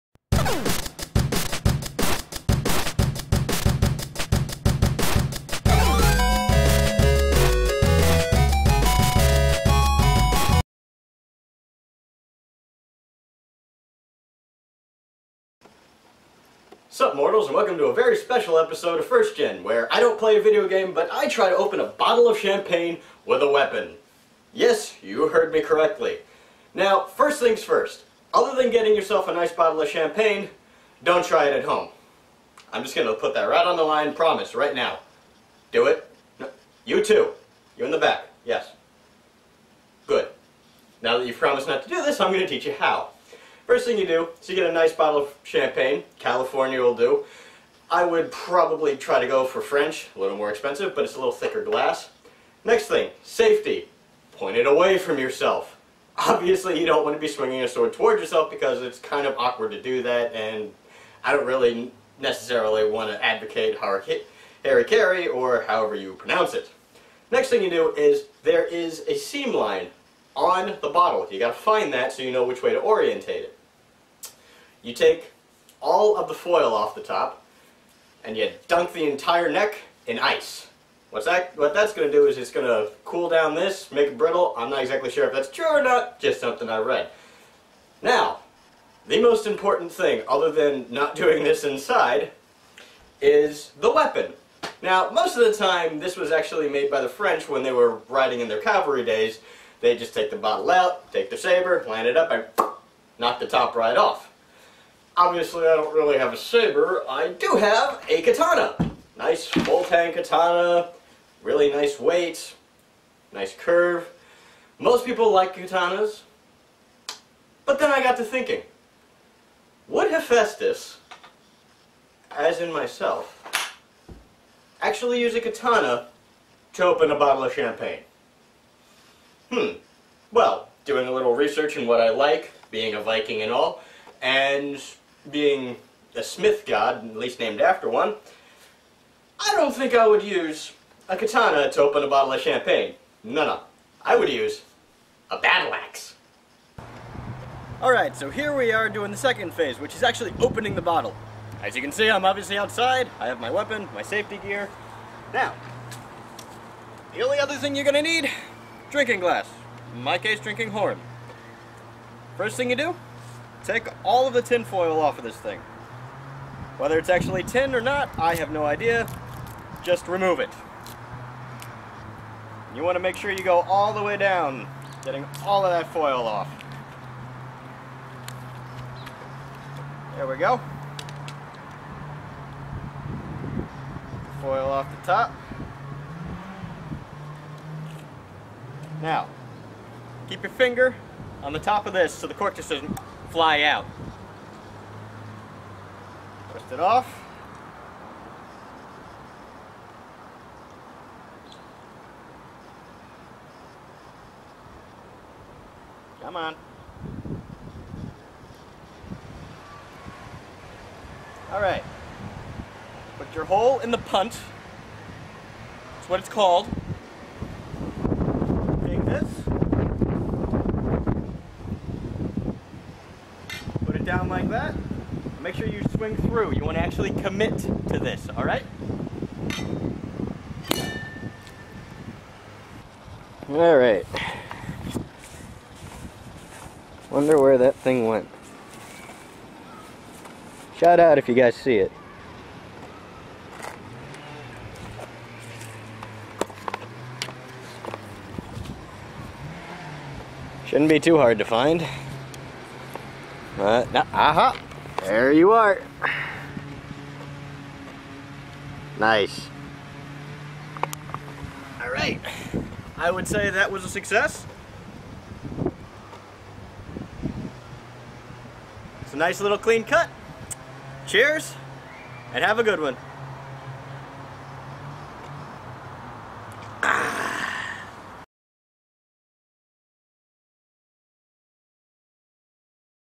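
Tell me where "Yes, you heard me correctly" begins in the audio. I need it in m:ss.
0:24.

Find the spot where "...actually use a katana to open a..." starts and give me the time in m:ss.
2:04.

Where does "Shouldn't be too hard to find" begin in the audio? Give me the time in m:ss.
4:10.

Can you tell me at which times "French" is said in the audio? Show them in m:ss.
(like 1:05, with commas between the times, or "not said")
0:49, 1:37.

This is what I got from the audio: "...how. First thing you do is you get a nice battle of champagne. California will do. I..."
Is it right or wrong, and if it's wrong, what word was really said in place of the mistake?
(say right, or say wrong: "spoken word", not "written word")
wrong: "bottle", not "battle".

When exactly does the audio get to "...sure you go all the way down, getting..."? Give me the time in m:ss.
2:53.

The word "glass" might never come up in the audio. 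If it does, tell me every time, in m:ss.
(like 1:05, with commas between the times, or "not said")
0:51, 2:39.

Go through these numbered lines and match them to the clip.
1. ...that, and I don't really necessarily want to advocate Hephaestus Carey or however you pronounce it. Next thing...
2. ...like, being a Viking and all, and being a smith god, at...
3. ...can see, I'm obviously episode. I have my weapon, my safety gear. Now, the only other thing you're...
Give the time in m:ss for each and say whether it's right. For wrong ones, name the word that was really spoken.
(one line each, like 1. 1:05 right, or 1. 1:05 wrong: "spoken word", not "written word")
1. 1:00 wrong: "Harry", not "Hephaestus"
2. 2:12 right
3. 2:31 wrong: "outside", not "episode".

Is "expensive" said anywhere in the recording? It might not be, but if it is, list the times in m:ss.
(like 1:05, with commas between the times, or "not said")
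0:50.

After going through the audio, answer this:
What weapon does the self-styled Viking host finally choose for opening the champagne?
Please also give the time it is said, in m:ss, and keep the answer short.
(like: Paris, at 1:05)
Battle axe, at 2:25.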